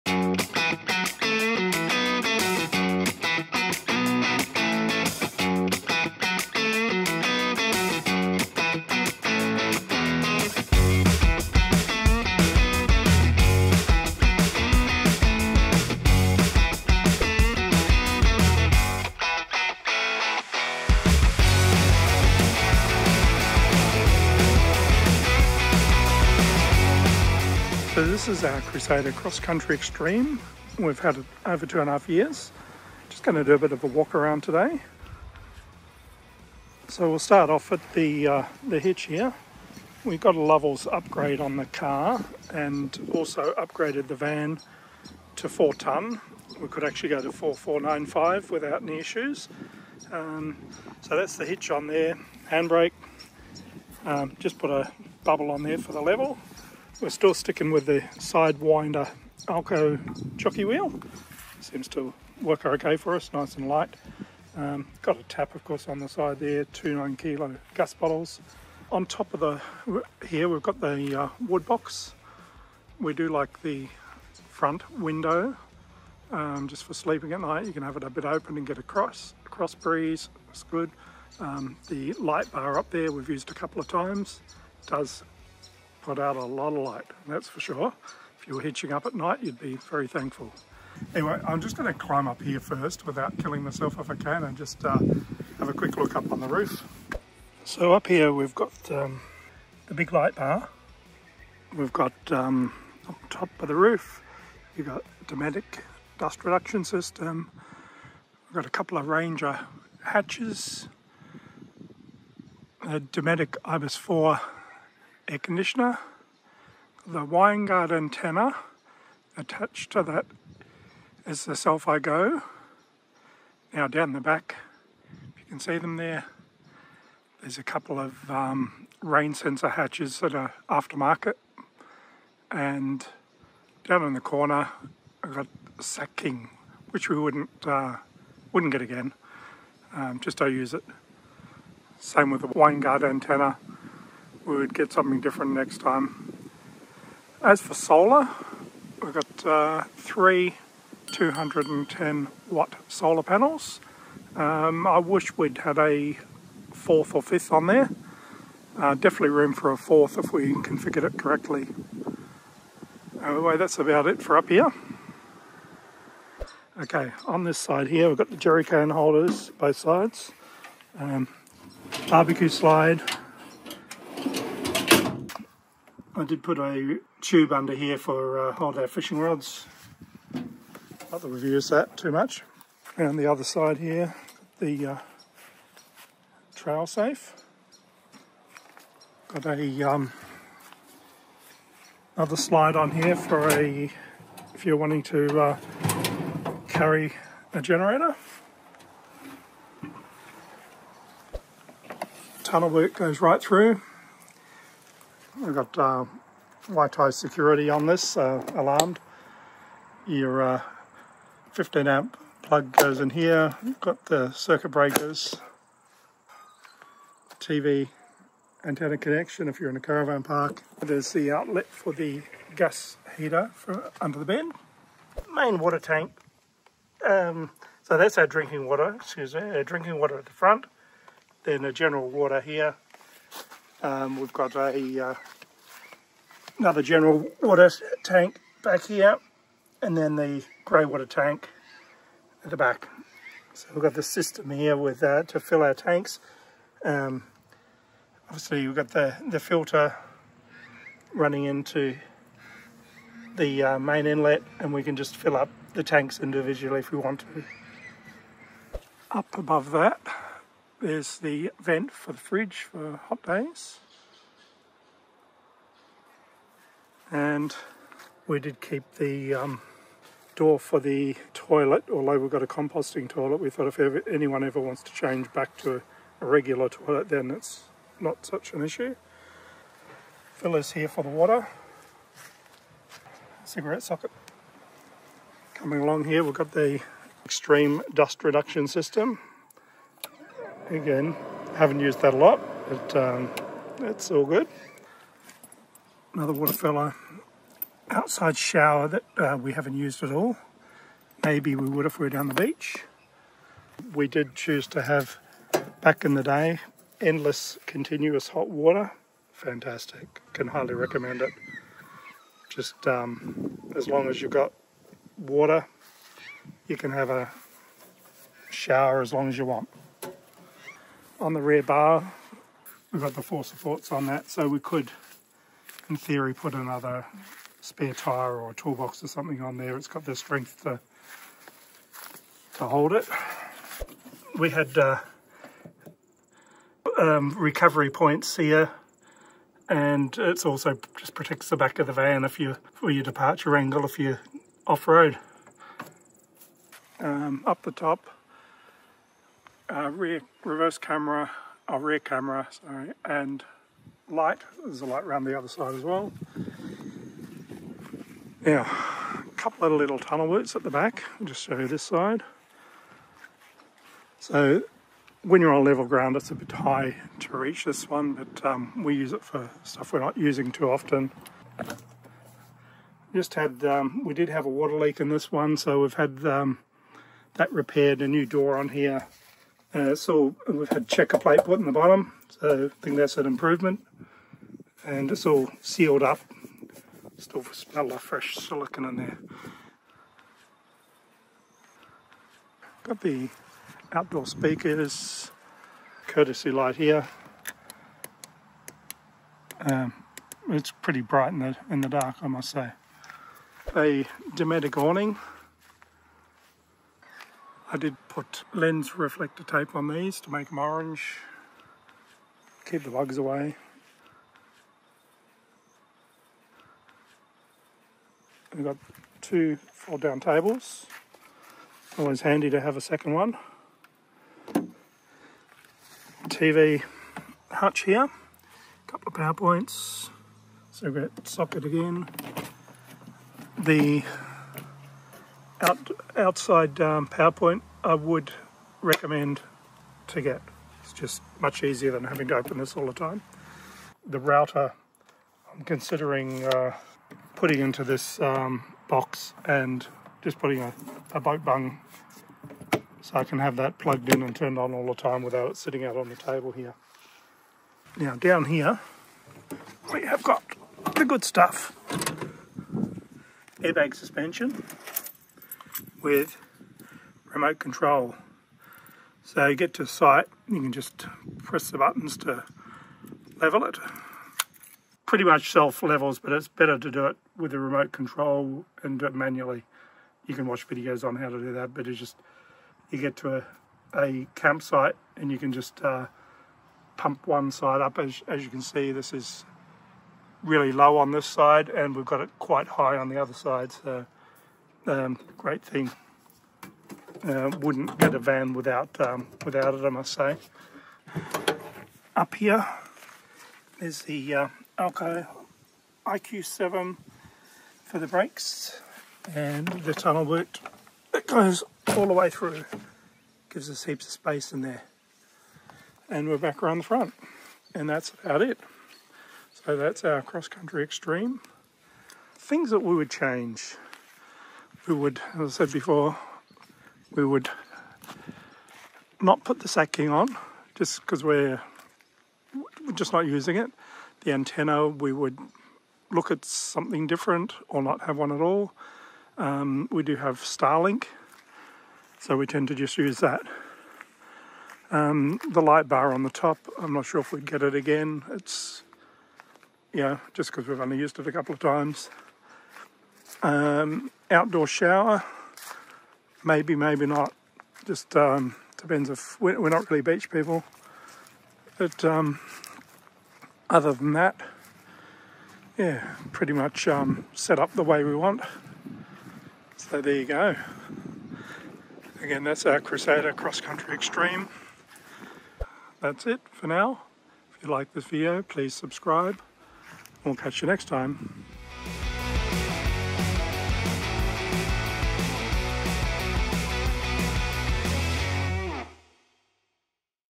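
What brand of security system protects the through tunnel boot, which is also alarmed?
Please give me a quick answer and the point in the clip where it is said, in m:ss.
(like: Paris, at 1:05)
Waito, at 3:26.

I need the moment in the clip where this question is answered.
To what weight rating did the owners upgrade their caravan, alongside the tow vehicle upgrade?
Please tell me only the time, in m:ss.
0:45.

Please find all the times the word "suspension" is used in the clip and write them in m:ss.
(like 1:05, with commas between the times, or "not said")
7:43.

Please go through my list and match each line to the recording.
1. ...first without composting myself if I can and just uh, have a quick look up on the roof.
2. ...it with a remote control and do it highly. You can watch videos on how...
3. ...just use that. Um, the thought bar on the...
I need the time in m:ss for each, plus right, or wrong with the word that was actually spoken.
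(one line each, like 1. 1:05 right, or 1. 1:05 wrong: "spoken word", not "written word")
1. 1:32 wrong: "killing", not "composting"
2. 7:57 wrong: "manually", not "highly"
3. 9:02 wrong: "light", not "thought".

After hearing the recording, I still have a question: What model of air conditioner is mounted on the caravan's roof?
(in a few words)
Dometic IBIS 4.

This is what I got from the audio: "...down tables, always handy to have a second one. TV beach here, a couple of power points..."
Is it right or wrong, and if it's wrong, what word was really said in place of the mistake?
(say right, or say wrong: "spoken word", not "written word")
wrong: "hutch", not "beach".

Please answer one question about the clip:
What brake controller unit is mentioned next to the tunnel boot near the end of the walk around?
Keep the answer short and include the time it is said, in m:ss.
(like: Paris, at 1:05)
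AL-KO IQ7, at 8:24.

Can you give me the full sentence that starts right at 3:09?
Got a um, another slide on here for a if you're wanting to uh, carry a generator.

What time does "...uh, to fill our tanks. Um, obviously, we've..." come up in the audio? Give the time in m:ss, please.
4:05.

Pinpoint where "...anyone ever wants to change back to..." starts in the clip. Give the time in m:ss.
4:34.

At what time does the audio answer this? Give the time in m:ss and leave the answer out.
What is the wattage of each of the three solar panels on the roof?
2:31.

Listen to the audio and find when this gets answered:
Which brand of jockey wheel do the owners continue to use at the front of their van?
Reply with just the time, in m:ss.
0:58.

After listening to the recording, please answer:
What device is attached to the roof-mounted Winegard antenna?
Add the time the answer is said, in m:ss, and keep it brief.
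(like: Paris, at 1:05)
Cel-Fi GO, at 2:01.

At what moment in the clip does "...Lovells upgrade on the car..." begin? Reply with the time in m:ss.
0:40.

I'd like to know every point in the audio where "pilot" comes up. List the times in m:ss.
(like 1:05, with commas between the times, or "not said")
not said.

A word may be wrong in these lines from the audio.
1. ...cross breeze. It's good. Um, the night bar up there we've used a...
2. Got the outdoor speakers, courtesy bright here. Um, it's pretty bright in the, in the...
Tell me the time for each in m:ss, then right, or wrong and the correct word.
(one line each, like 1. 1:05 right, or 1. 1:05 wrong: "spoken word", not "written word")
1. 1:19 wrong: "light", not "night"
2. 6:32 wrong: "light", not "bright".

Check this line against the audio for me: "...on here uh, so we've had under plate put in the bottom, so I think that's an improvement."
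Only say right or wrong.
wrong.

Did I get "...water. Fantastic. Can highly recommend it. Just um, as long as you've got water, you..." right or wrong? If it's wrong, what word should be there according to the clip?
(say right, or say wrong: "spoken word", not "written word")
right.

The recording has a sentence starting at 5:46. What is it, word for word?
Um, up the top rear reverse camera, our oh, rear camera, sorry, and light.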